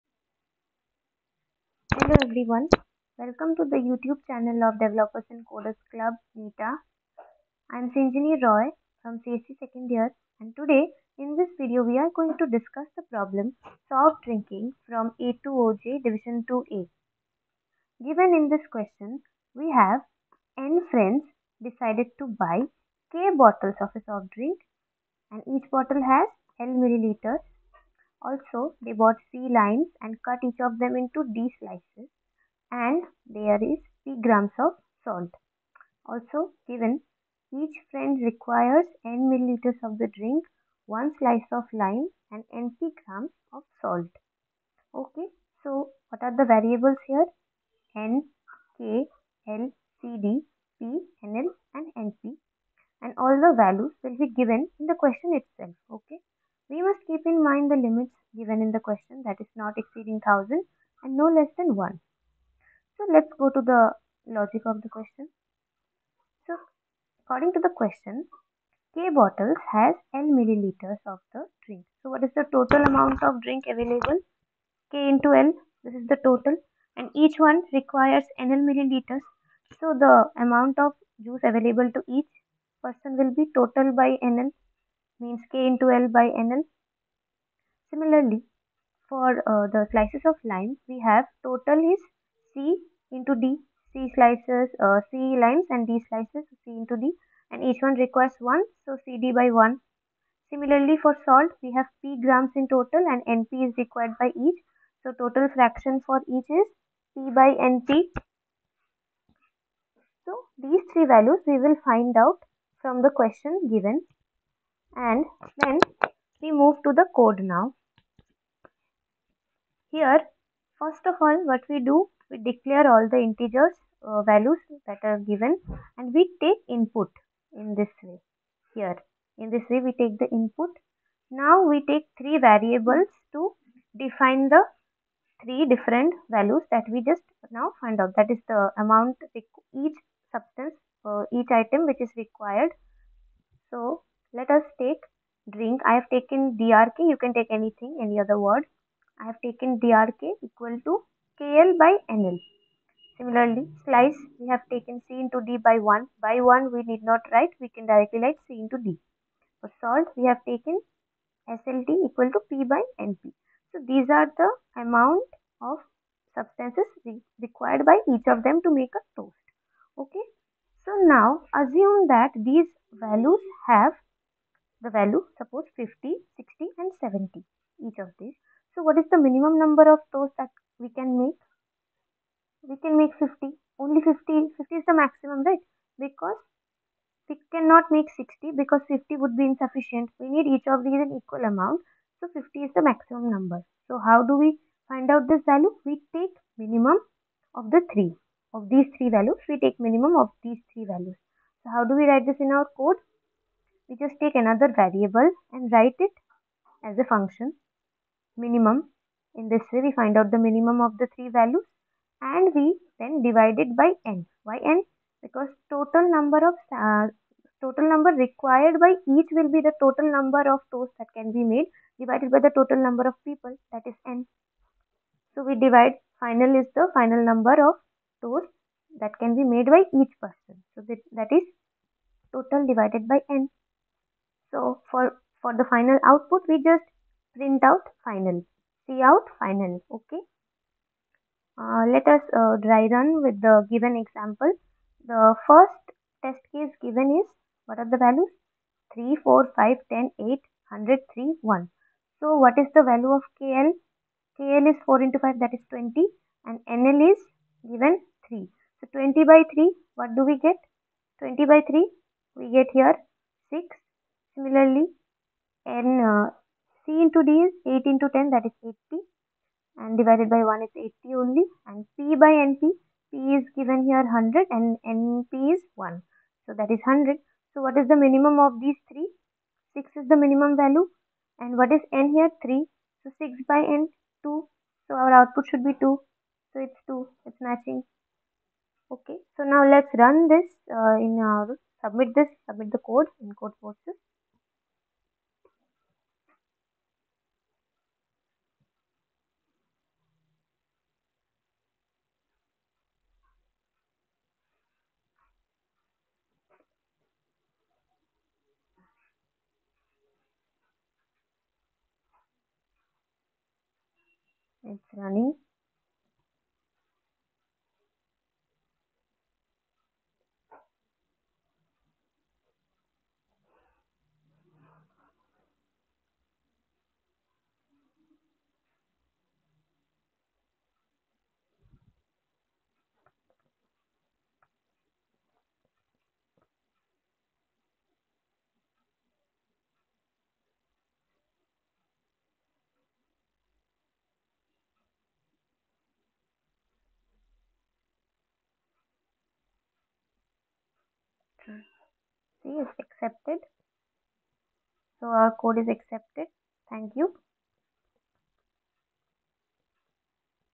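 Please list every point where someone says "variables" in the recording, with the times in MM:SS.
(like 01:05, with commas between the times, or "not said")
00:46, 02:12, 03:24.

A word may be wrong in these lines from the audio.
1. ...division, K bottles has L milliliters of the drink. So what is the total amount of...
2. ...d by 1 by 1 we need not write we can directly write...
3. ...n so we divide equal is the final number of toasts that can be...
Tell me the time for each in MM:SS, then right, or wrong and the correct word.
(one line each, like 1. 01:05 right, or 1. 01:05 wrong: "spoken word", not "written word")
1. 01:07 wrong: "question", not "division"
2. 02:35 right
3. 03:44 wrong: "final", not "equal".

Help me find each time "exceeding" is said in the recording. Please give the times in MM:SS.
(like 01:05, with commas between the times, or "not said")
00:59.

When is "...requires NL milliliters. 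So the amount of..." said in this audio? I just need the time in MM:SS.
01:17.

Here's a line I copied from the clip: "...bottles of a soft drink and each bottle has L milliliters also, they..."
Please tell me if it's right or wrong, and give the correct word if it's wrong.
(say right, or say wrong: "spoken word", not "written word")
right.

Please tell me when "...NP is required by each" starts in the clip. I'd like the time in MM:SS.
01:43.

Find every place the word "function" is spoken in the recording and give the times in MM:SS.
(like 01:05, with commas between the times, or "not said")
03:27.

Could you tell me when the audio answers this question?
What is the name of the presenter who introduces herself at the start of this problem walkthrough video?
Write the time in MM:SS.
00:07.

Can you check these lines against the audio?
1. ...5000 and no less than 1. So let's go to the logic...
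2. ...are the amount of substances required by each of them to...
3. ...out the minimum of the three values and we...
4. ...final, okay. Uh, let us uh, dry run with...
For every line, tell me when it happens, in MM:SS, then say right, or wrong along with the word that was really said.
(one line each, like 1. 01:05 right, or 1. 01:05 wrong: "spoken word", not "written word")
1. 01:00 wrong: "1000", not "5000"
2. 02:44 right
3. 03:30 right
4. 03:59 right.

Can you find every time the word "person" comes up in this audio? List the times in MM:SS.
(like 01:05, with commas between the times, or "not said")
01:22, 03:50.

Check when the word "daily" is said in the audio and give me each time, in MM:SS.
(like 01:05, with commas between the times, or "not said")
not said.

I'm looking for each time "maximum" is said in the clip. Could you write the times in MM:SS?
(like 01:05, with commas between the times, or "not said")
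03:04, 03:12.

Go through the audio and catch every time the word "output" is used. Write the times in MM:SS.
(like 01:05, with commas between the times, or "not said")
03:56, 04:45.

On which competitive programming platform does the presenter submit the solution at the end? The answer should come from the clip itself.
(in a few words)
Codeforces.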